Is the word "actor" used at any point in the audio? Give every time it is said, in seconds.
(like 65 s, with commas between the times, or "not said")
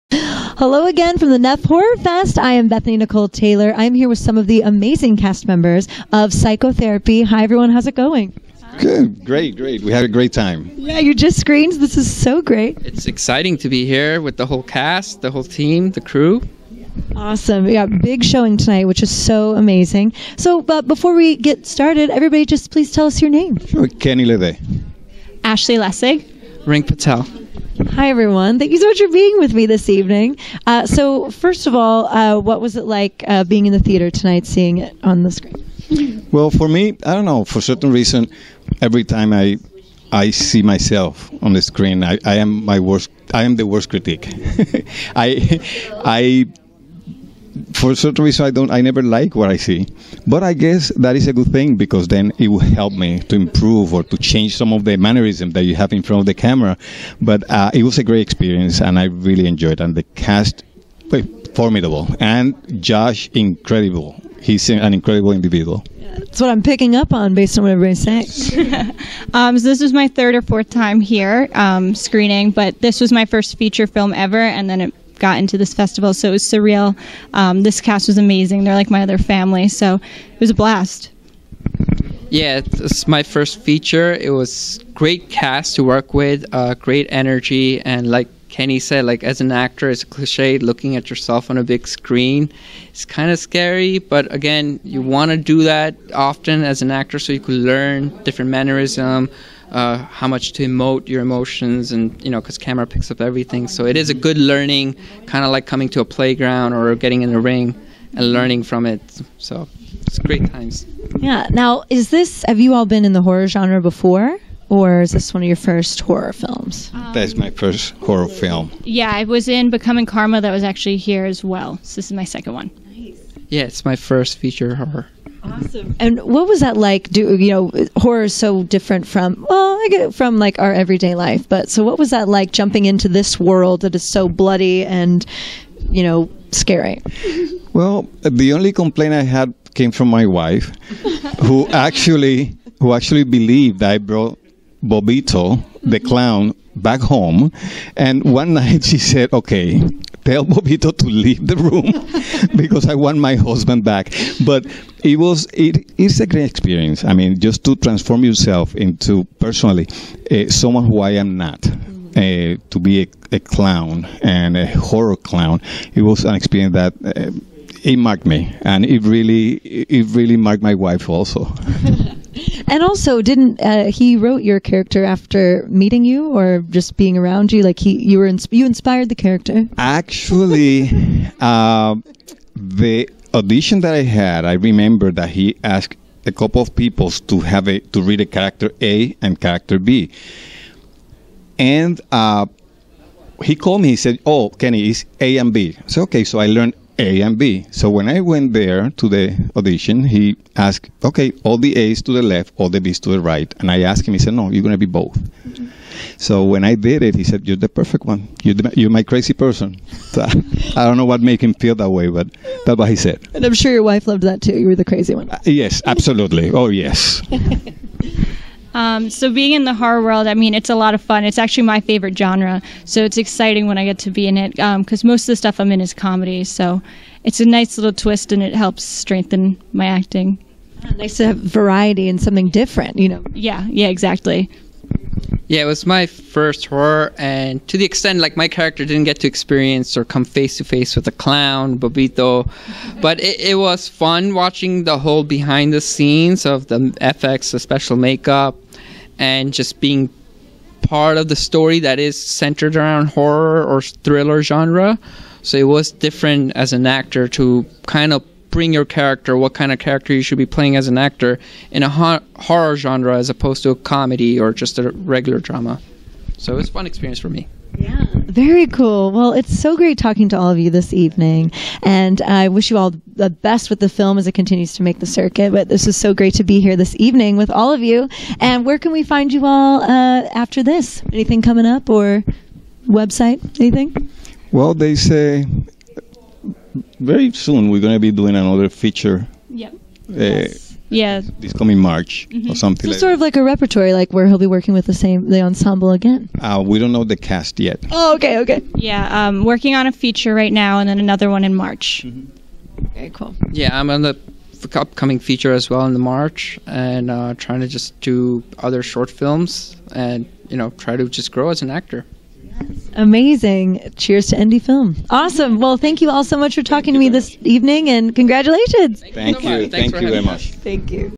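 89 s, 96 s, 256 s, 260 s, 311 s.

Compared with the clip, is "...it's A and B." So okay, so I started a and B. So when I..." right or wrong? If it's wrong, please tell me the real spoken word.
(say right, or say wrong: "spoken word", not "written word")
wrong: "learned", not "started".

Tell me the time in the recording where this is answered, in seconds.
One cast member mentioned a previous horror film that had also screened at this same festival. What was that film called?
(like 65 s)
119 s.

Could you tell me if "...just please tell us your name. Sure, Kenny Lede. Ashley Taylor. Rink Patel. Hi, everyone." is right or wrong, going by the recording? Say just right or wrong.
wrong.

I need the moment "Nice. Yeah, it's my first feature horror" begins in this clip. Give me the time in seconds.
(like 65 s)
122 s.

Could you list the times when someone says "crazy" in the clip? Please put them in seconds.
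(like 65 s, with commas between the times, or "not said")
209 s, 214 s.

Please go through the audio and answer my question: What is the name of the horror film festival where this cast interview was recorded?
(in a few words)
Neff Horror Fest.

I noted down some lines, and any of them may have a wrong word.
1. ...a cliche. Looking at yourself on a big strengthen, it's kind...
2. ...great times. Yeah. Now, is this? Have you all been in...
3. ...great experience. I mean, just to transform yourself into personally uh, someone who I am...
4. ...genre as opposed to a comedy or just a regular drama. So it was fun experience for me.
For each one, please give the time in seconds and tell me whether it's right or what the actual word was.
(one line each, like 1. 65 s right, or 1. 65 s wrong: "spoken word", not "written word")
1. 90 s wrong: "screen", not "strengthen"
2. 110 s right
3. 156 s right
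4. 262 s right.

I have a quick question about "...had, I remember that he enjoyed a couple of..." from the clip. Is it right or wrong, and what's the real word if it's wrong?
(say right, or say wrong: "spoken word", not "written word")
wrong: "asked", not "enjoyed".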